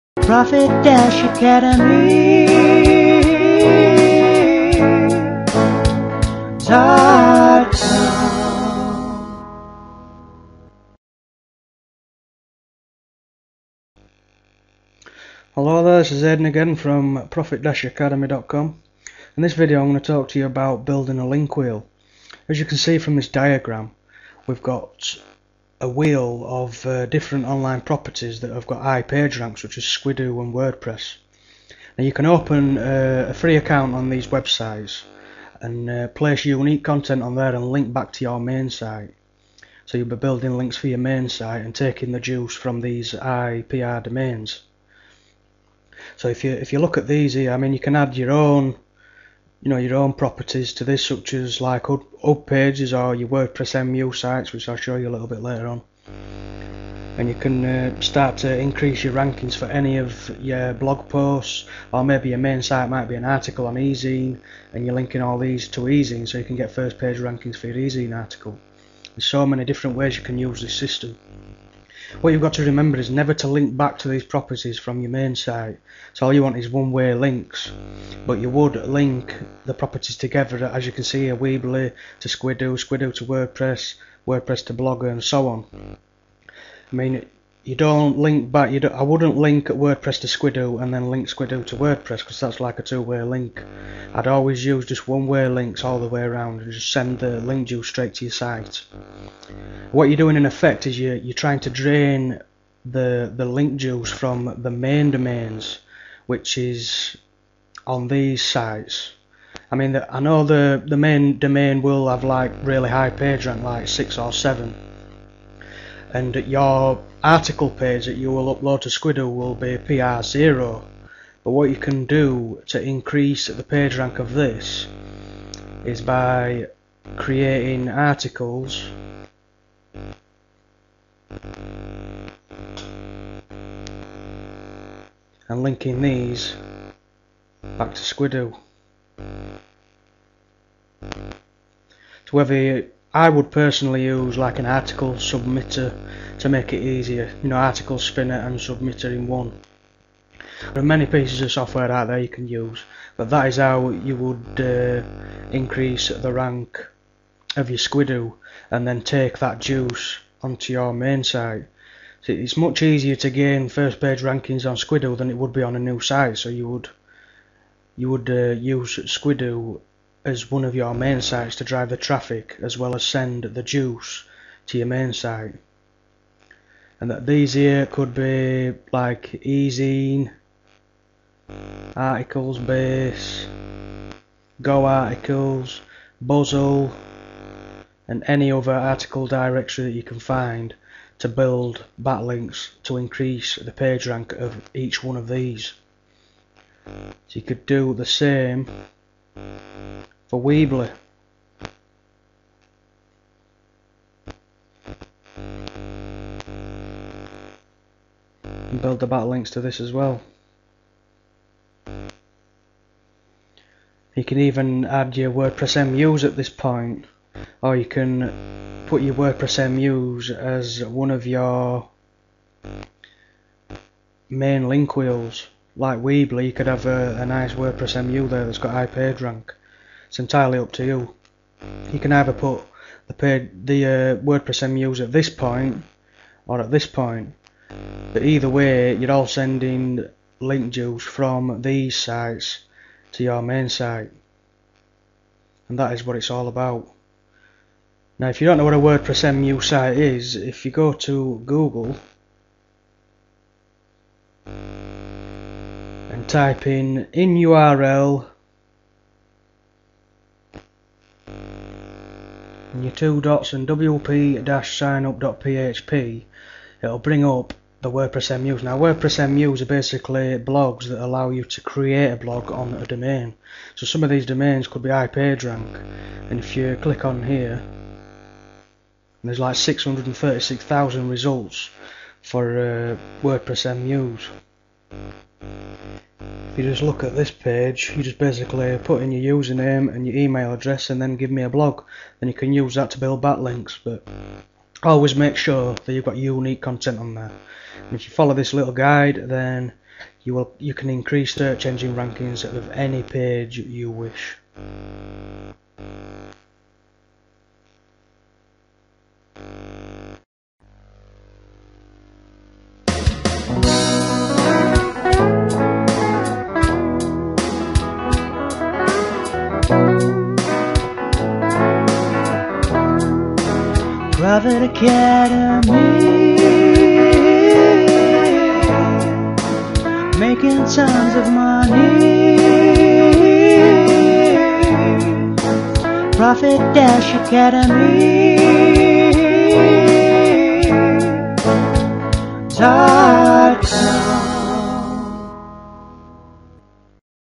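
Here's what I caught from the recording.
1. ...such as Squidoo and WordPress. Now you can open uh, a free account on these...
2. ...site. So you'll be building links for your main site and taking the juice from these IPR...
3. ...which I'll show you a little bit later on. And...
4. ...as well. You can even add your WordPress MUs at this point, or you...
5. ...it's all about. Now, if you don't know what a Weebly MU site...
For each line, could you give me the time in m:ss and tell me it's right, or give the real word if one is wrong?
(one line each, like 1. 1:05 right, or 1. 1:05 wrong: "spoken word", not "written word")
1. 0:29 right
2. 0:38 right
3. 0:54 right
4. 3:29 right
5. 4:06 wrong: "WordPress", not "Weebly".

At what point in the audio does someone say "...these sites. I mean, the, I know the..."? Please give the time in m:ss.
1:48.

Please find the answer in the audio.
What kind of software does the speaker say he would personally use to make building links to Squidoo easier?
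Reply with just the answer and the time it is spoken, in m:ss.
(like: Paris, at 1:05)
article submitter, at 2:24.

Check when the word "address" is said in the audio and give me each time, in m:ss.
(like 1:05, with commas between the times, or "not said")
4:50.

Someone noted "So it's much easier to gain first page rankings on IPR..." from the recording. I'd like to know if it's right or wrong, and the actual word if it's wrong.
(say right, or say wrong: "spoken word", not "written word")
wrong: "Squidoo", not "IPR".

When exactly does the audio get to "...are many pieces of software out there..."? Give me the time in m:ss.
2:30.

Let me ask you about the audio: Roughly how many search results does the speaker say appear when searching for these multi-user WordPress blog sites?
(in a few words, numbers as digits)
636,000.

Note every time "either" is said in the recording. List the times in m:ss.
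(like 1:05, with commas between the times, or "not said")
3:52, 3:58.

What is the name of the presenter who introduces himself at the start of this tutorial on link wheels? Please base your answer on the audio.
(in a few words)
Aidan.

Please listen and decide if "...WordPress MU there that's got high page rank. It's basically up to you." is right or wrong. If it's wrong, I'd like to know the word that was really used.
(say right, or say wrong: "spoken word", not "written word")
wrong: "entirely", not "basically".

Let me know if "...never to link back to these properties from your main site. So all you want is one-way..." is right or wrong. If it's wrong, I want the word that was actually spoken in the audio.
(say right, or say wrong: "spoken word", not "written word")
right.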